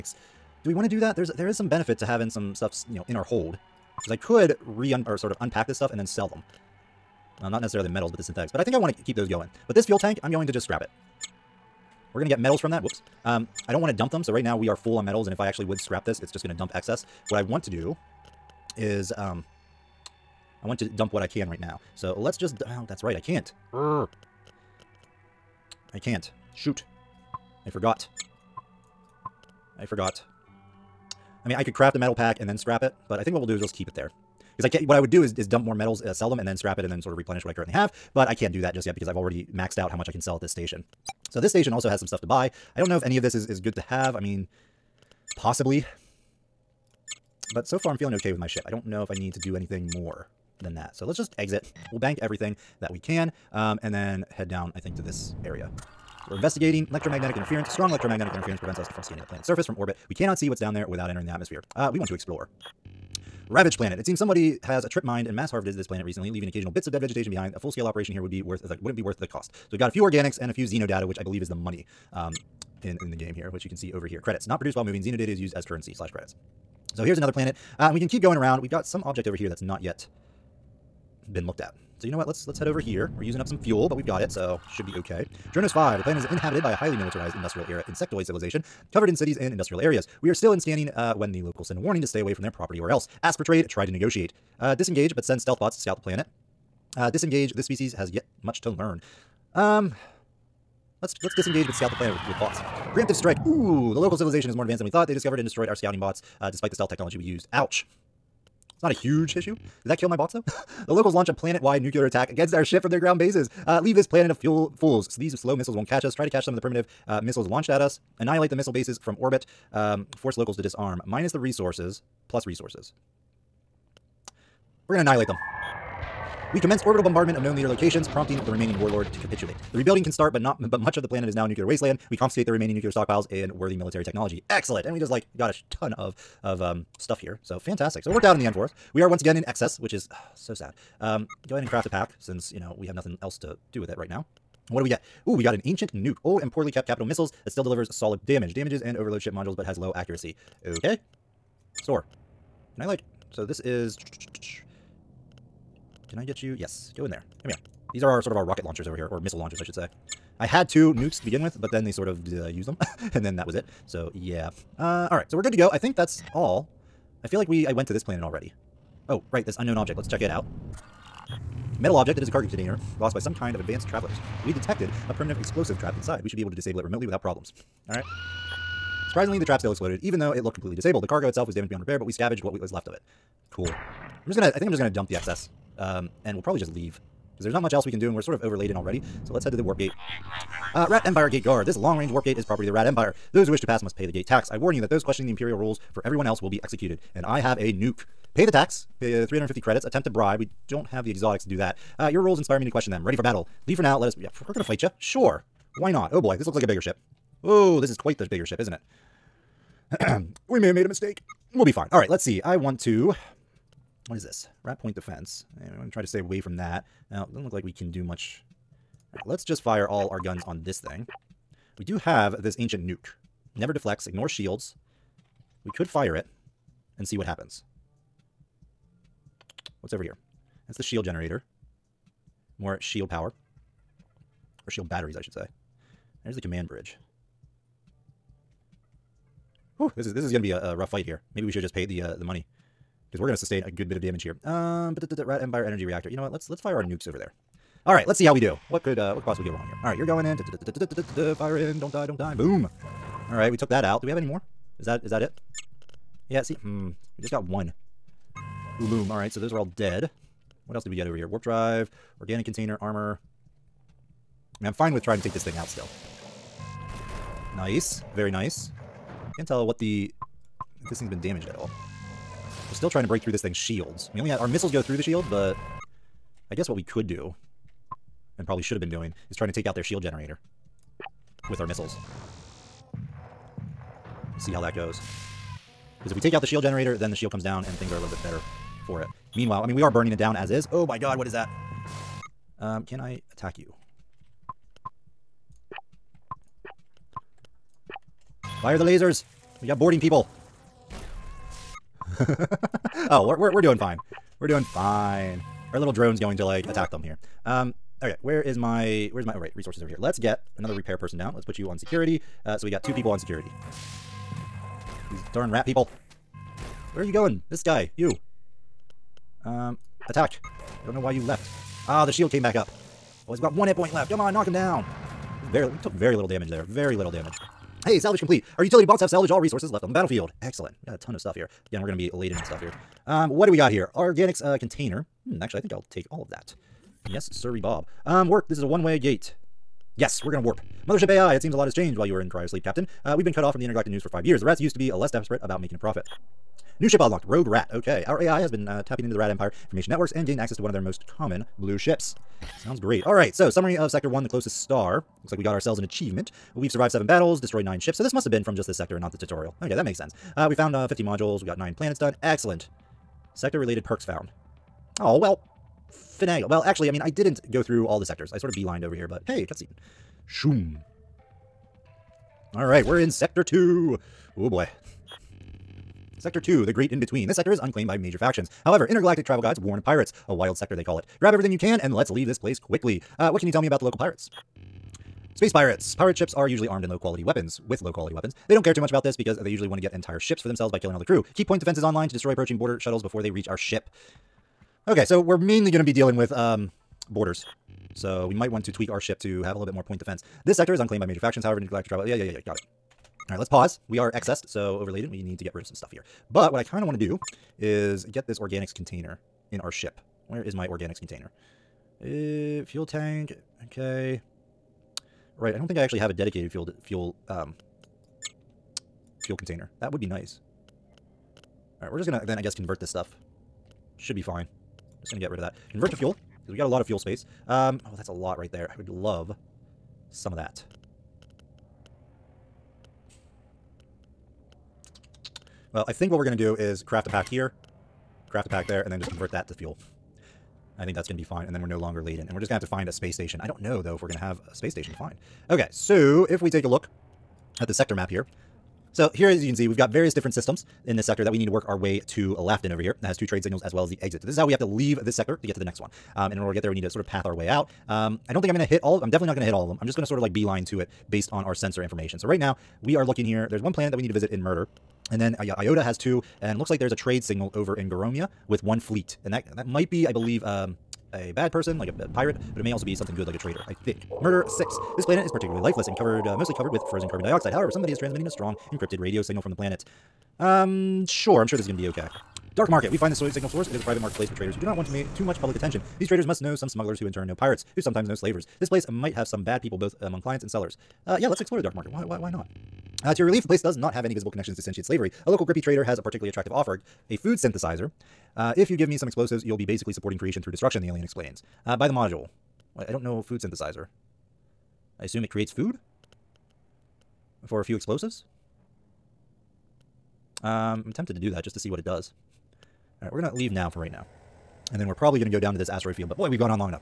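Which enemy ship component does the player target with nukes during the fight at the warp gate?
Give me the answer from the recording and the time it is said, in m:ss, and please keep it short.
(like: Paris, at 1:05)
Energy Reactor, at 4:05.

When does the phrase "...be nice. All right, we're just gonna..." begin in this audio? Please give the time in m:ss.
7:00.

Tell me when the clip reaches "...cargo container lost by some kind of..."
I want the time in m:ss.
2:52.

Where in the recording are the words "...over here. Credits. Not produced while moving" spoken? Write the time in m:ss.
1:13.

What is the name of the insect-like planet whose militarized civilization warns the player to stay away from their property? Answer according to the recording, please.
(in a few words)
Dronos 5.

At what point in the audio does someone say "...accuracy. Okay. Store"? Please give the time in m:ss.
2:29.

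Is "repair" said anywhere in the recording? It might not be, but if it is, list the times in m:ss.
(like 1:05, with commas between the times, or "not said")
3:01, 5:10.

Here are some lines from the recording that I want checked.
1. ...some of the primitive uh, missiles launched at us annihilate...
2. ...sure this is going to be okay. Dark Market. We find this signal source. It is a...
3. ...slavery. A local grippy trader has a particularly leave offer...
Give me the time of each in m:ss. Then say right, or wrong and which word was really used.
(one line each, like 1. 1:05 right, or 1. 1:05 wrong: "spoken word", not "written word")
1. 1:56 right
2. 8:01 right
3. 8:14 wrong: "attractive", not "leave".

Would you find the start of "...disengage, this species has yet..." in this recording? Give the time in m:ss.
1:37.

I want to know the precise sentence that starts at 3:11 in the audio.
This long-range warp gate is property of the Rat Empire.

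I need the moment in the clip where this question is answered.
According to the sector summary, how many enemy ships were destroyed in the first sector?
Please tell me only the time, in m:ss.
5:57.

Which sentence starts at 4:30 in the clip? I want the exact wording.
If this thing's been damaged at all.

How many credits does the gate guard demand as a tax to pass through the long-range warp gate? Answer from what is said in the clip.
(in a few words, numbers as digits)
350.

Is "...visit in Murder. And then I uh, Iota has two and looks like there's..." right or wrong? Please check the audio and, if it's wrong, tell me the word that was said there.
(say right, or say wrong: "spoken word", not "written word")
right.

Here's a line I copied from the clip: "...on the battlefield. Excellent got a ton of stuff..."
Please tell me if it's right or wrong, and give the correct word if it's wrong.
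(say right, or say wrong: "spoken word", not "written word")
right.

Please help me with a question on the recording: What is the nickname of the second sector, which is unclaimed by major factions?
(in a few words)
The Great In-Between.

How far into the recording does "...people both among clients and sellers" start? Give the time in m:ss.
8:09.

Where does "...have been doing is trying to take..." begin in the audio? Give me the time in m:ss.
4:38.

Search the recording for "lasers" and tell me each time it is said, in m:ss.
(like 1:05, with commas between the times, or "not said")
4:58.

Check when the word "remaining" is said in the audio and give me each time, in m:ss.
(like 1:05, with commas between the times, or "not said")
2:08, 2:12.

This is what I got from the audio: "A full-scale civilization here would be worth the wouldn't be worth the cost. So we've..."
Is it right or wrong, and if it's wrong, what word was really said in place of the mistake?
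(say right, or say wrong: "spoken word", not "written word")
wrong: "operation", not "civilization".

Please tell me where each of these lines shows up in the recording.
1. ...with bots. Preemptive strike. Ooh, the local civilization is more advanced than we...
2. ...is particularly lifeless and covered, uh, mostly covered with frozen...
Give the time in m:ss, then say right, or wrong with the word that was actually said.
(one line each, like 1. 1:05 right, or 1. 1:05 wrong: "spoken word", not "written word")
1. 1:42 right
2. 7:55 right.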